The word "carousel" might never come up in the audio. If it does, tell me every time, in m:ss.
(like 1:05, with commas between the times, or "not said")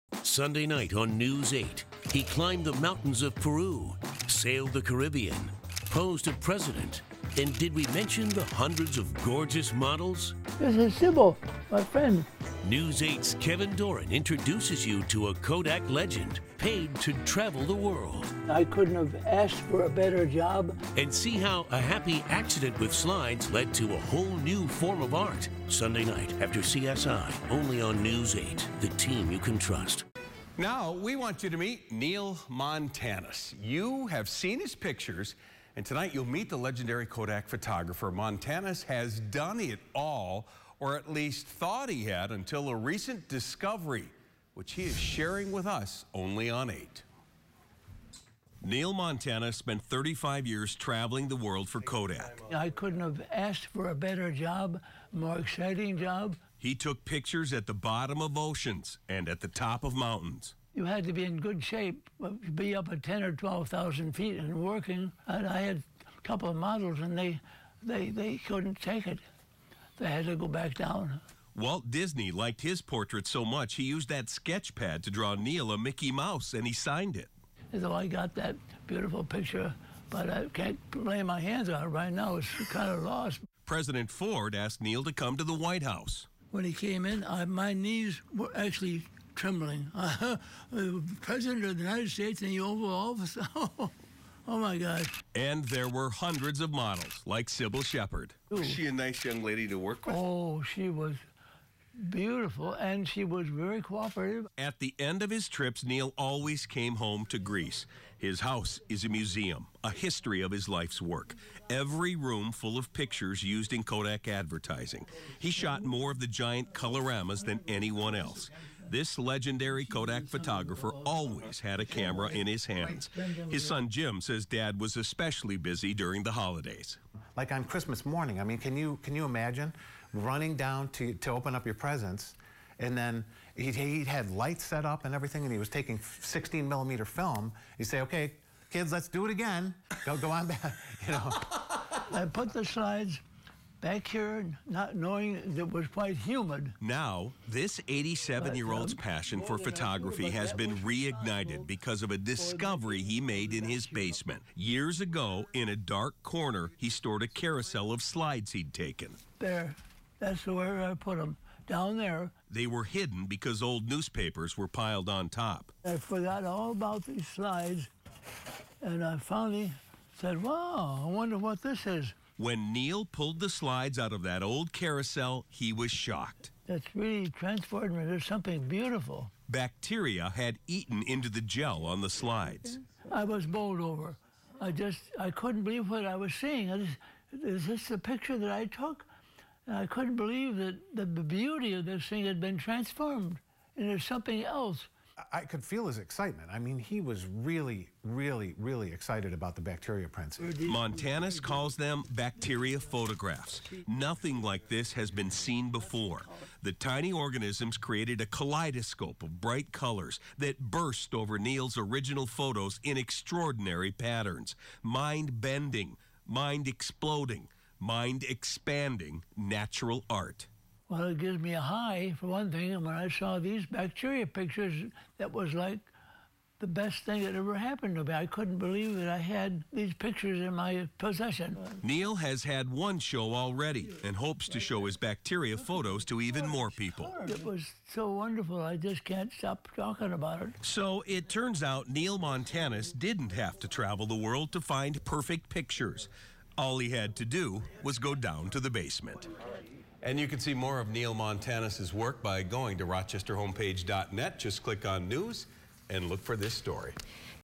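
2:37, 2:54.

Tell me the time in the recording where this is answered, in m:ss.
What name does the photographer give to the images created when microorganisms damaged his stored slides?
3:22.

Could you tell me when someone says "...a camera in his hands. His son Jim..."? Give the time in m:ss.
2:01.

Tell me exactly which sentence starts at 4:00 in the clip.
So it turns out Neil Montanus didn't have to travel the world to find perfect pictures.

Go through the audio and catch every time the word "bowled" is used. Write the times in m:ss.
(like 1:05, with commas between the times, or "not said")
3:03.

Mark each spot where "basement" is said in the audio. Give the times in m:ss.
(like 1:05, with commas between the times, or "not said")
2:33, 4:08.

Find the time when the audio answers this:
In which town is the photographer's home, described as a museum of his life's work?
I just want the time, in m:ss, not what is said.
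1:47.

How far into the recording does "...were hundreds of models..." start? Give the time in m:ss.
1:35.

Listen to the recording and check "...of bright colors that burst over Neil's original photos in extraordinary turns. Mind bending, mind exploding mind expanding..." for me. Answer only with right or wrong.
wrong.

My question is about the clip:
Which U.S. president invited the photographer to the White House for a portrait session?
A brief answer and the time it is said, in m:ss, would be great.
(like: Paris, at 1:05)
President Ford, at 1:23.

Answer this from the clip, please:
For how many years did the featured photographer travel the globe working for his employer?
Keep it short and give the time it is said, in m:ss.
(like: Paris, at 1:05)
35, at 0:49.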